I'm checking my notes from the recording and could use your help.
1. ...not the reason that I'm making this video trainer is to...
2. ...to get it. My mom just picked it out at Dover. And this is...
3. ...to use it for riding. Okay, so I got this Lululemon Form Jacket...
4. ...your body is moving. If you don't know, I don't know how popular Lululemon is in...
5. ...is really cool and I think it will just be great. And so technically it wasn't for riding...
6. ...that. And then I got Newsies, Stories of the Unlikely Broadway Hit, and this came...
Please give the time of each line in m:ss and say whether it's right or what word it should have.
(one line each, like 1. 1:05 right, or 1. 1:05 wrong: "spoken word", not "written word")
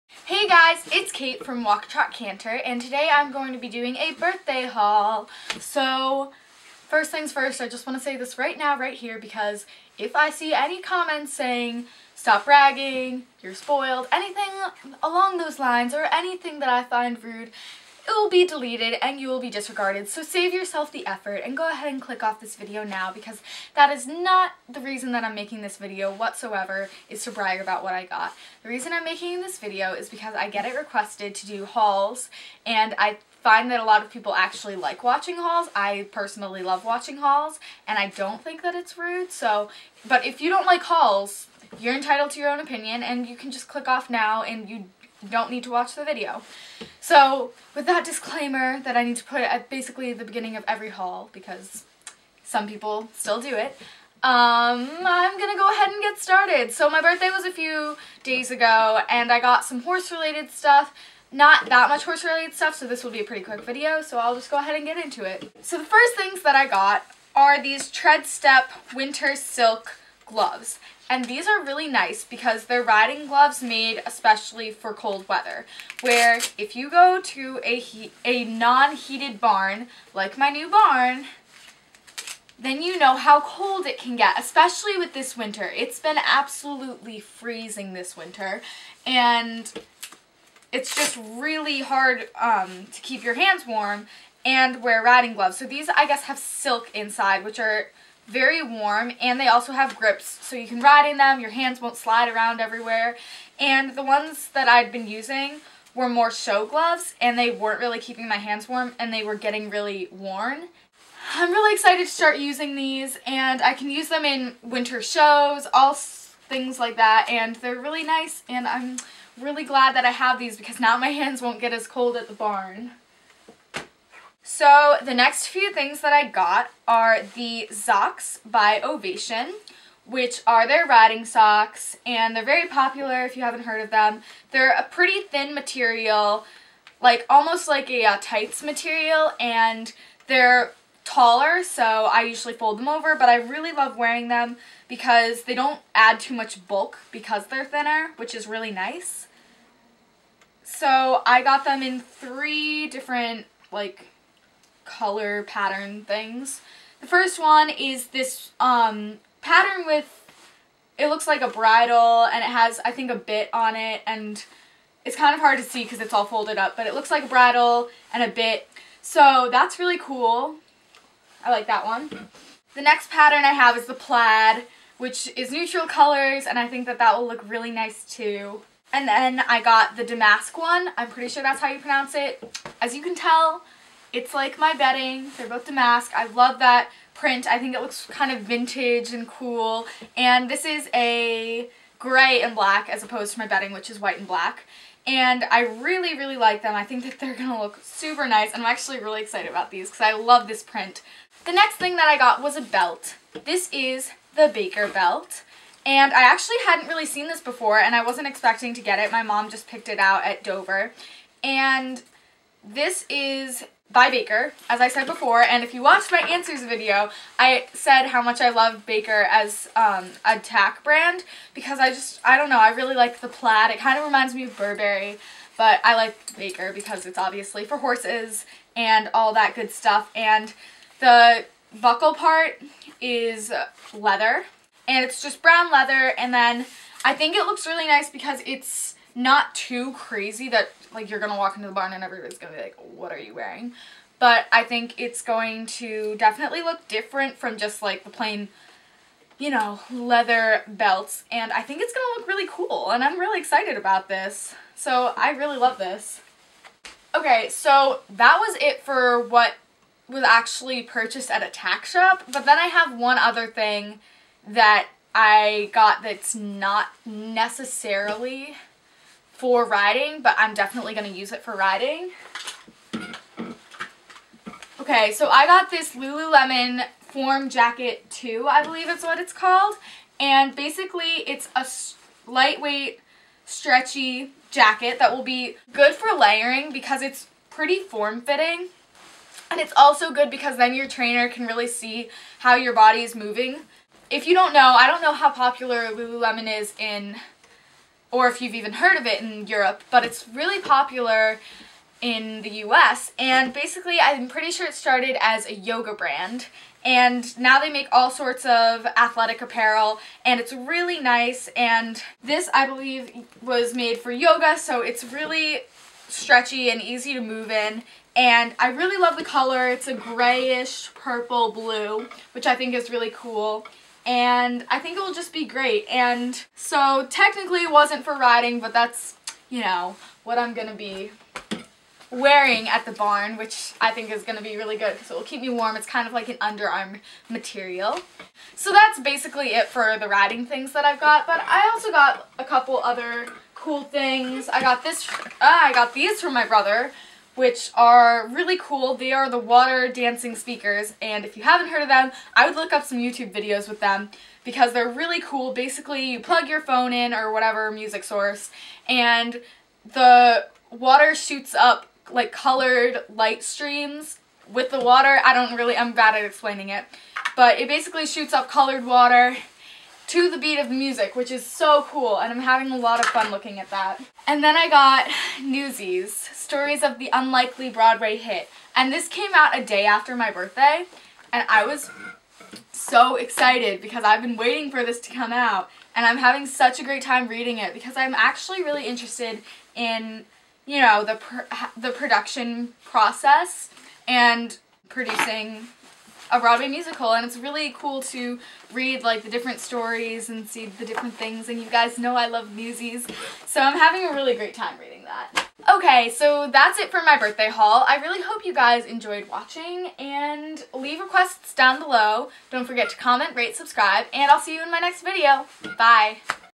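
1. 0:24 wrong: "whatsoever", not "trainer"
2. 3:28 right
3. 4:31 right
4. 4:52 right
5. 5:22 right
6. 6:13 right.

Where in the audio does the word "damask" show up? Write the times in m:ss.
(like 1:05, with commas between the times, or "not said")
3:00, 3:05.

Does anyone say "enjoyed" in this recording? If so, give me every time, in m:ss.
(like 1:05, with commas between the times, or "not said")
6:48.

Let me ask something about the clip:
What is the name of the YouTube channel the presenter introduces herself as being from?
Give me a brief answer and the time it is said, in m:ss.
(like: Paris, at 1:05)
Walk Trot Canter, at 0:01.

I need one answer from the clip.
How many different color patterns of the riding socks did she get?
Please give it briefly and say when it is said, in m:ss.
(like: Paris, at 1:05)
3, at 2:31.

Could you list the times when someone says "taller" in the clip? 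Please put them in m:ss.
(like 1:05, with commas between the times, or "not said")
2:21.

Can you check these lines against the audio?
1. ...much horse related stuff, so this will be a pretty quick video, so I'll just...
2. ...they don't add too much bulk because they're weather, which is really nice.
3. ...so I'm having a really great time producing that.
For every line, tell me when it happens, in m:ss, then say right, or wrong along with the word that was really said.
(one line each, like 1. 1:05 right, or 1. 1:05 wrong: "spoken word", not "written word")
1. 1:01 right
2. 2:25 wrong: "thinner", not "weather"
3. 6:43 wrong: "reading", not "producing".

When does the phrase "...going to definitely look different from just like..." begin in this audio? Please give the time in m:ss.
4:05.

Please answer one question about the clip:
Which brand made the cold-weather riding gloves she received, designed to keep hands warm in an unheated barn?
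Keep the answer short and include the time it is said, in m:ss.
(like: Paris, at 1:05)
Tredstep, at 1:07.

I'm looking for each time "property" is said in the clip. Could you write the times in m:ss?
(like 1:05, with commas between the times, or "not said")
not said.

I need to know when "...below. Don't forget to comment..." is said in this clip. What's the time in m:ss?
6:51.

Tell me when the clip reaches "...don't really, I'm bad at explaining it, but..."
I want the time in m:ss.
6:05.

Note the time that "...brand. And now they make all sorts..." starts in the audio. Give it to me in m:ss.
5:05.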